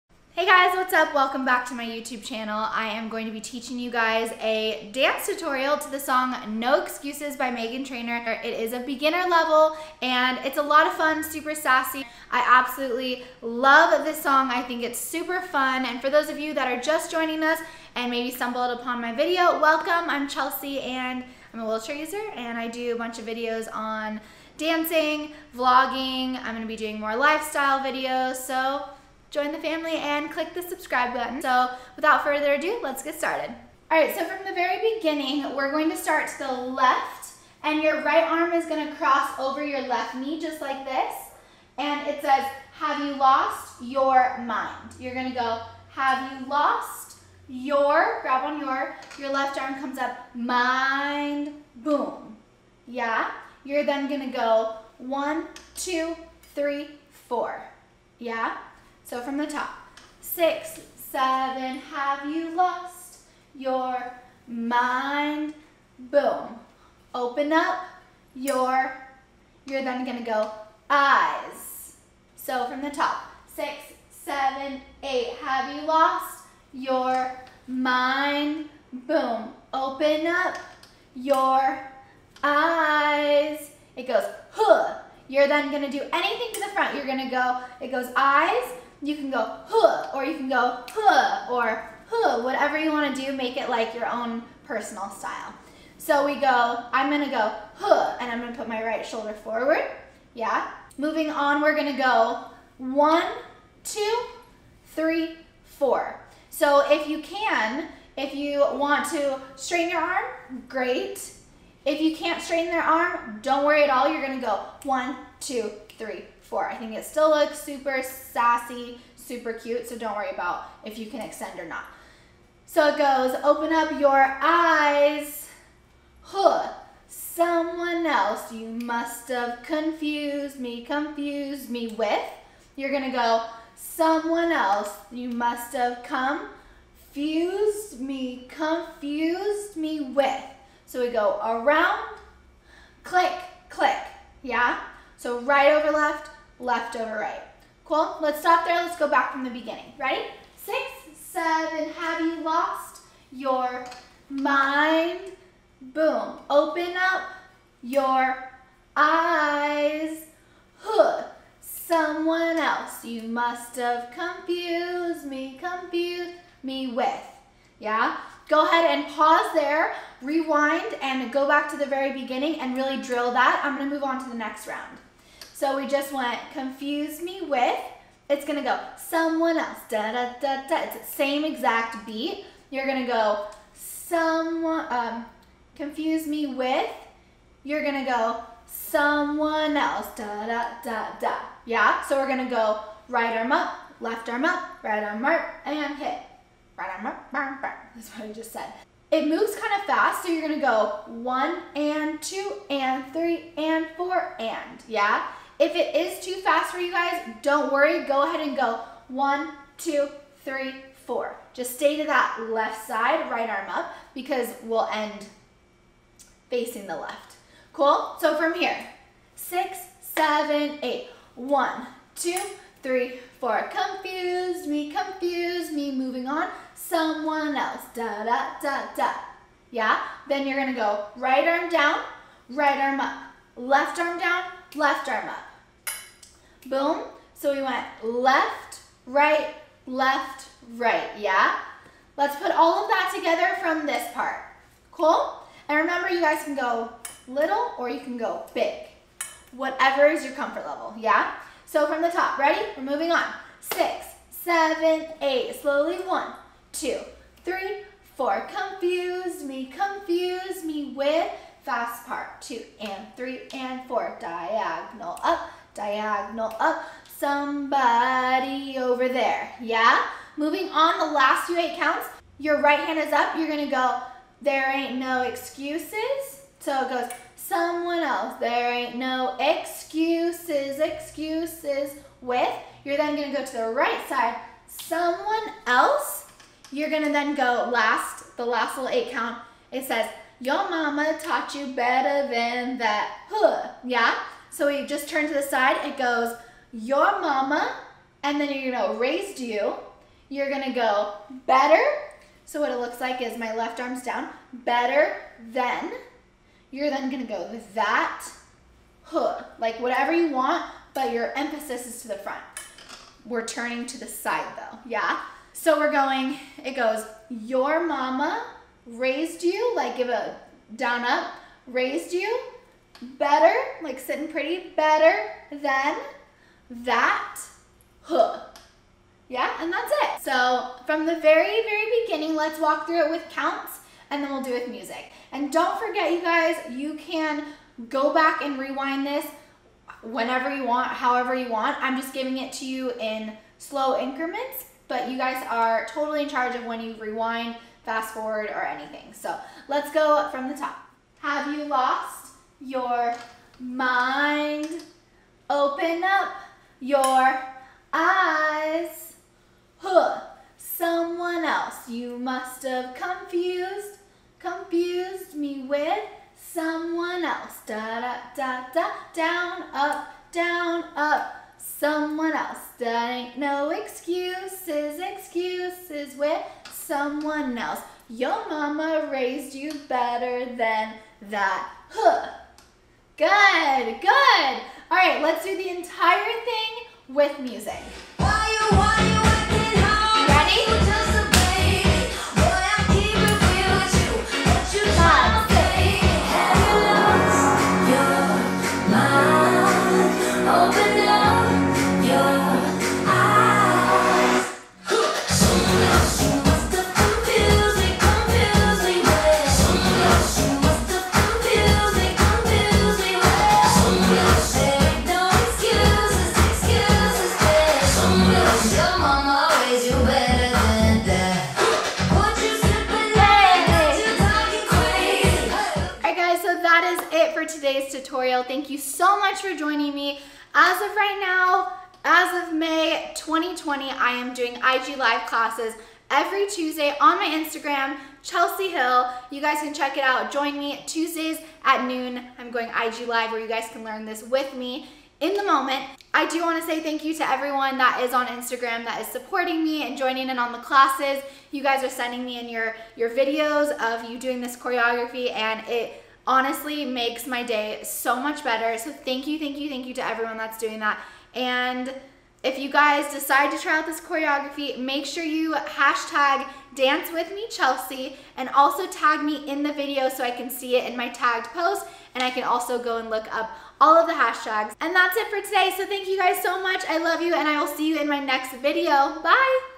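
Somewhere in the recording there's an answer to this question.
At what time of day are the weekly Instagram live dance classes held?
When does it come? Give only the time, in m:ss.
7:21.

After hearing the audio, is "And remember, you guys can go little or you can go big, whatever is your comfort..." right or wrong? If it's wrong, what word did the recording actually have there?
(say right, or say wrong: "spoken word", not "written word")
right.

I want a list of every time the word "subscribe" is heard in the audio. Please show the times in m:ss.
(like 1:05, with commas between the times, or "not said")
0:30.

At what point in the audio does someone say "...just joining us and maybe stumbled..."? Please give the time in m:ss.
0:16.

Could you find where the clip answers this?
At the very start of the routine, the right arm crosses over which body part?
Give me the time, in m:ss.
0:39.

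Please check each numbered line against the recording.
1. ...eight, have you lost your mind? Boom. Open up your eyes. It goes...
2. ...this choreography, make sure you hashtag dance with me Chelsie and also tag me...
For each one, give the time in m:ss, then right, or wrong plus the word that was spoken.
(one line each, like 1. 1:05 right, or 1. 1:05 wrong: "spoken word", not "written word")
1. 1:15 right
2. 7:43 right.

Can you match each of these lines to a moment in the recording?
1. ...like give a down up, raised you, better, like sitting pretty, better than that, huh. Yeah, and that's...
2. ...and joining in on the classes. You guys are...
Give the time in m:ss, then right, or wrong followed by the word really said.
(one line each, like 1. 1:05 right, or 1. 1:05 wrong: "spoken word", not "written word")
1. 5:19 right
2. 7:29 right.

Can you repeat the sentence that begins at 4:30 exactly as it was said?
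Moving on the last few eight counts, your right hand is up, you're gonna go, there ain't no excuses.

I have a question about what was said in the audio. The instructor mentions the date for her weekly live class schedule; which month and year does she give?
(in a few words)
May 2020.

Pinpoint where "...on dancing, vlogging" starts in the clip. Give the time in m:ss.
0:23.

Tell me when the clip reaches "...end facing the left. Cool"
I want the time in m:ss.
3:34.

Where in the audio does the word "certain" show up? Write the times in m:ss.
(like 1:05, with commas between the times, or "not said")
not said.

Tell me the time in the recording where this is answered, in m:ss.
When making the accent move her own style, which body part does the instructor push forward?
1:38.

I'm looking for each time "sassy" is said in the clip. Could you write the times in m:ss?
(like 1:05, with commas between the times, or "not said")
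0:11, 1:58.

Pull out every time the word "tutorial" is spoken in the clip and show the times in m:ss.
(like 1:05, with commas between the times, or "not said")
0:05, 7:07.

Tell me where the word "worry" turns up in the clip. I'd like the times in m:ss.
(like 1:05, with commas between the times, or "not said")
1:53, 2:00, 3:27.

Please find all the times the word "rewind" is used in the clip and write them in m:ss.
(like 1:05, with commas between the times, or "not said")
2:50, 5:38, 5:46.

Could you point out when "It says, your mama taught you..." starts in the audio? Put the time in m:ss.
4:49.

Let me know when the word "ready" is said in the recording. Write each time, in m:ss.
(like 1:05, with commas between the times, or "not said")
2:29, 4:12.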